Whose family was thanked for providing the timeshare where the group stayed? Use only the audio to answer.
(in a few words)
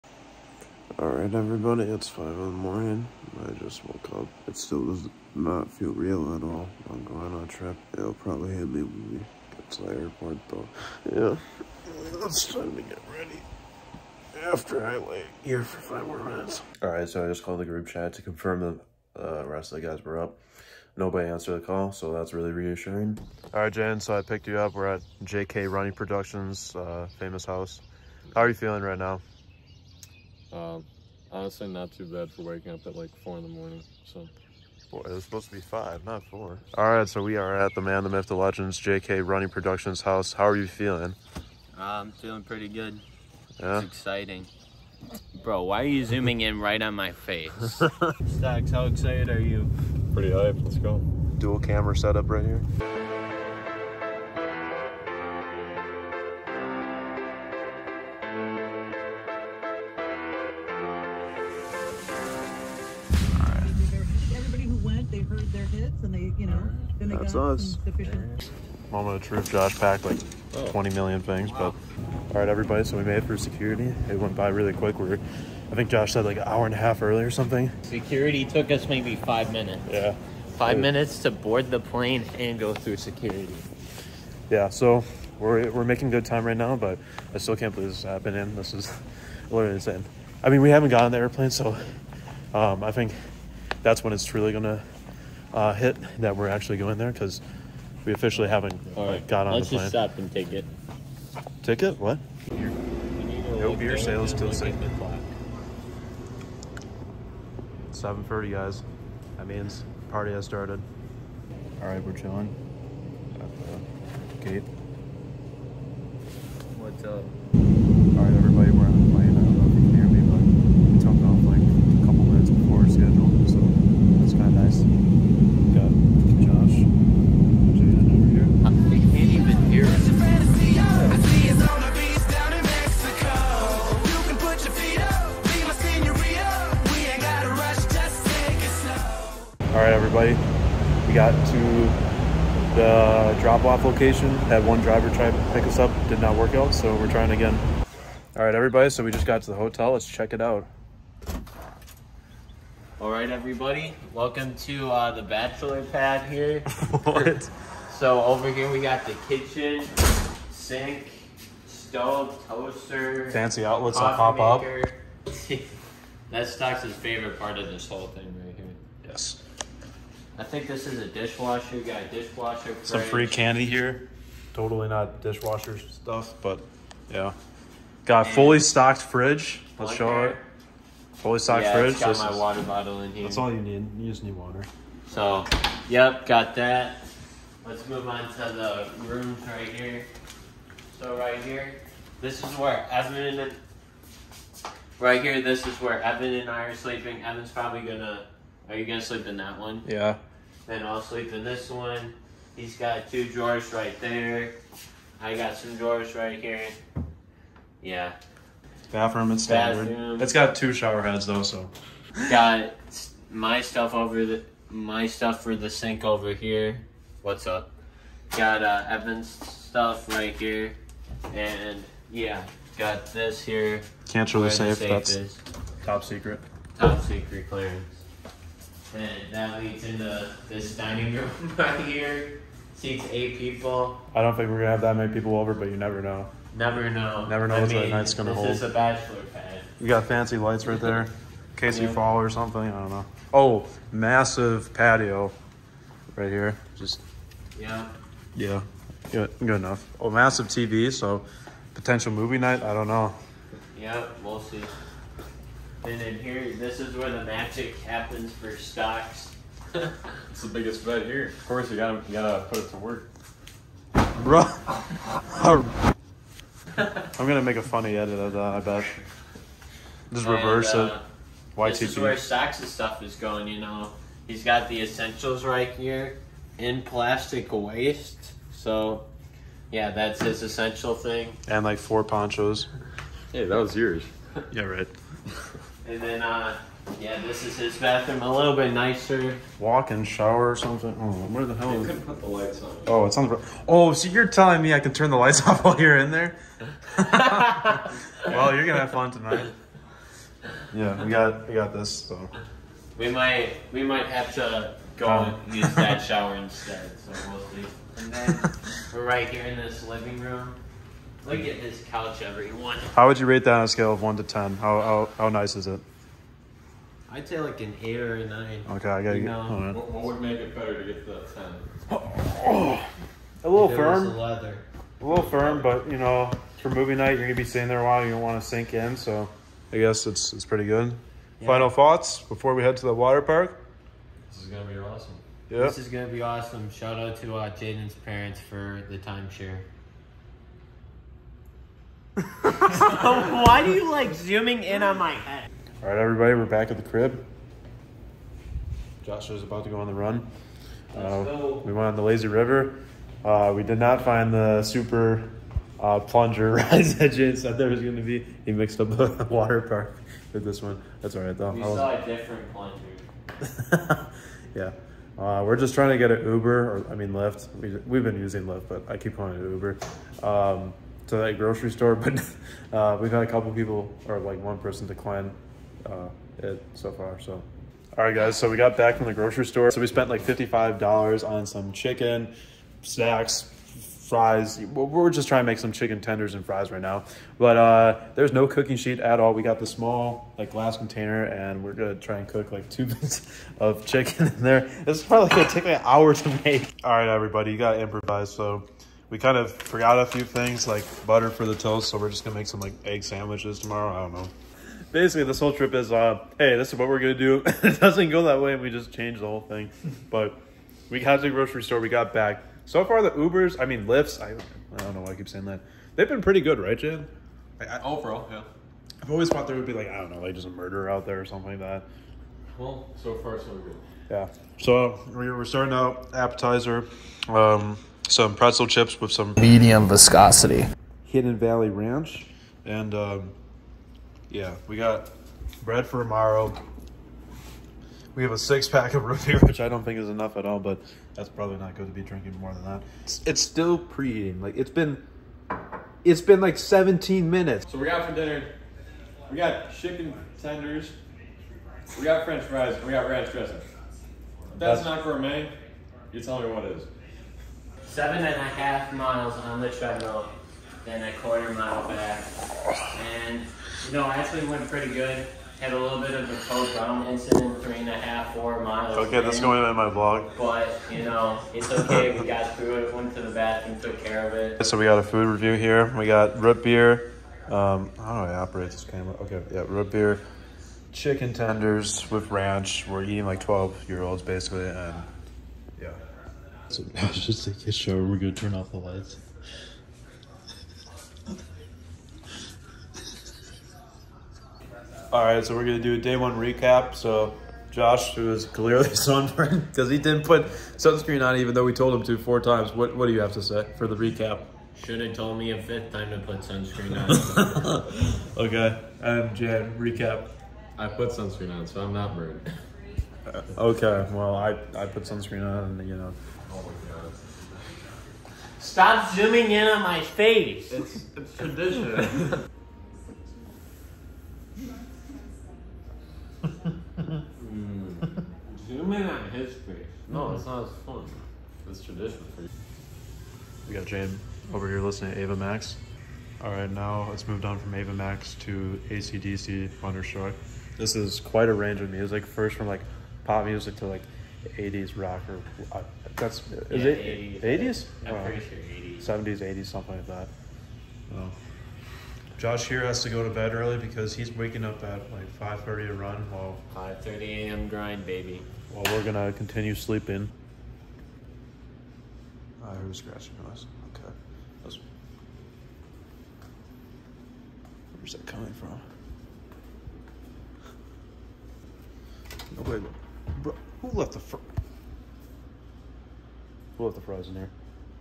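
Jaden's parents.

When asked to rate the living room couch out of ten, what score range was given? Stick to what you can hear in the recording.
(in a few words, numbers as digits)
8 or 9.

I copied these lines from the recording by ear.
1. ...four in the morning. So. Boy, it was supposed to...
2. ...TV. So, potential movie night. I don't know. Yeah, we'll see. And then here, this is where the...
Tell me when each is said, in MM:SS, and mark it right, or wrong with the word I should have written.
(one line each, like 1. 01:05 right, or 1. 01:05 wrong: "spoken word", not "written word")
1. 00:33 right
2. 04:10 right.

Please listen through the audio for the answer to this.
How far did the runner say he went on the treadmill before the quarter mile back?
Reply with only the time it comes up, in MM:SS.
07:37.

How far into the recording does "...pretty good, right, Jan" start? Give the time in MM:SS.
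06:56.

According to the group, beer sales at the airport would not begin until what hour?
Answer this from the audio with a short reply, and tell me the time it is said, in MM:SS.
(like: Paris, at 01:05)
6, at 01:43.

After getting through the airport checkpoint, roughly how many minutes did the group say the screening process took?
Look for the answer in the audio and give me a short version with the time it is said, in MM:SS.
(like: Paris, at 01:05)
5, at 01:18.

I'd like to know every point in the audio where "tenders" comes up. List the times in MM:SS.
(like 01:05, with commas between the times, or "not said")
06:26, 07:30, 08:01.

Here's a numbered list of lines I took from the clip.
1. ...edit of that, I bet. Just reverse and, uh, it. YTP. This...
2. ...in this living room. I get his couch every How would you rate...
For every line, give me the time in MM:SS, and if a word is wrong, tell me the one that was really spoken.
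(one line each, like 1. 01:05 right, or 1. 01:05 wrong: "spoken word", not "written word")
1. 04:27 right
2. 05:09 right.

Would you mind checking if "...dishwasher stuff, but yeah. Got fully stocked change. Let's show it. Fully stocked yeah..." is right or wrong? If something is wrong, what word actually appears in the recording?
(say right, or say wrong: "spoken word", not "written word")
wrong: "fridge", not "change".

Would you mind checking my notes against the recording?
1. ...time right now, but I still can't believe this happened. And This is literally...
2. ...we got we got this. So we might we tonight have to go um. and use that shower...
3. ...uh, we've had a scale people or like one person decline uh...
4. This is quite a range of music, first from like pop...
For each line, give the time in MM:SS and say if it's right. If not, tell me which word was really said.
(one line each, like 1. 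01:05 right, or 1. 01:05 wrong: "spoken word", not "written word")
1. 01:26 right
2. 05:01 wrong: "might", not "tonight"
3. 06:12 wrong: "couple", not "scale"
4. 09:00 right.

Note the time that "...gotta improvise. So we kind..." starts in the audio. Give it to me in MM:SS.
06:37.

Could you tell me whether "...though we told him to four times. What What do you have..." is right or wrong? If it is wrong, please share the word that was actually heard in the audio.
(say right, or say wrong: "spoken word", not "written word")
right.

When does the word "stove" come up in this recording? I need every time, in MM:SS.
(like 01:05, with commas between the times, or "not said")
02:41.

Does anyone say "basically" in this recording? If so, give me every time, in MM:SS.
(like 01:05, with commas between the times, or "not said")
06:44, 08:04.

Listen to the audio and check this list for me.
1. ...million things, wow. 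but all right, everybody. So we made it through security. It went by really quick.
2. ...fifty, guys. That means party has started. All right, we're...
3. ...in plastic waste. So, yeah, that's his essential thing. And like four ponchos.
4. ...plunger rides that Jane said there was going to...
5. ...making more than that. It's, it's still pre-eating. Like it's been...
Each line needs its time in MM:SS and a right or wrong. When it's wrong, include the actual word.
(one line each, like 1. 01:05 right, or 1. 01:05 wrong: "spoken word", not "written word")
1. 01:10 right
2. 01:48 wrong: "thirty", not "fifty"
3. 04:36 right
4. 05:56 right
5. 07:22 wrong: "drinking", not "making".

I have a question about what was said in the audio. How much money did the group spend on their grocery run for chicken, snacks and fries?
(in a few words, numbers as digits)
$55.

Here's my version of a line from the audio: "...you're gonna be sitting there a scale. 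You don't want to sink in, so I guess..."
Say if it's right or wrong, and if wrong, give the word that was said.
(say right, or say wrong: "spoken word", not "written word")
wrong: "while", not "scale".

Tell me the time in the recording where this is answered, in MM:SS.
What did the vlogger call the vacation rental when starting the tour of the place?
02:35.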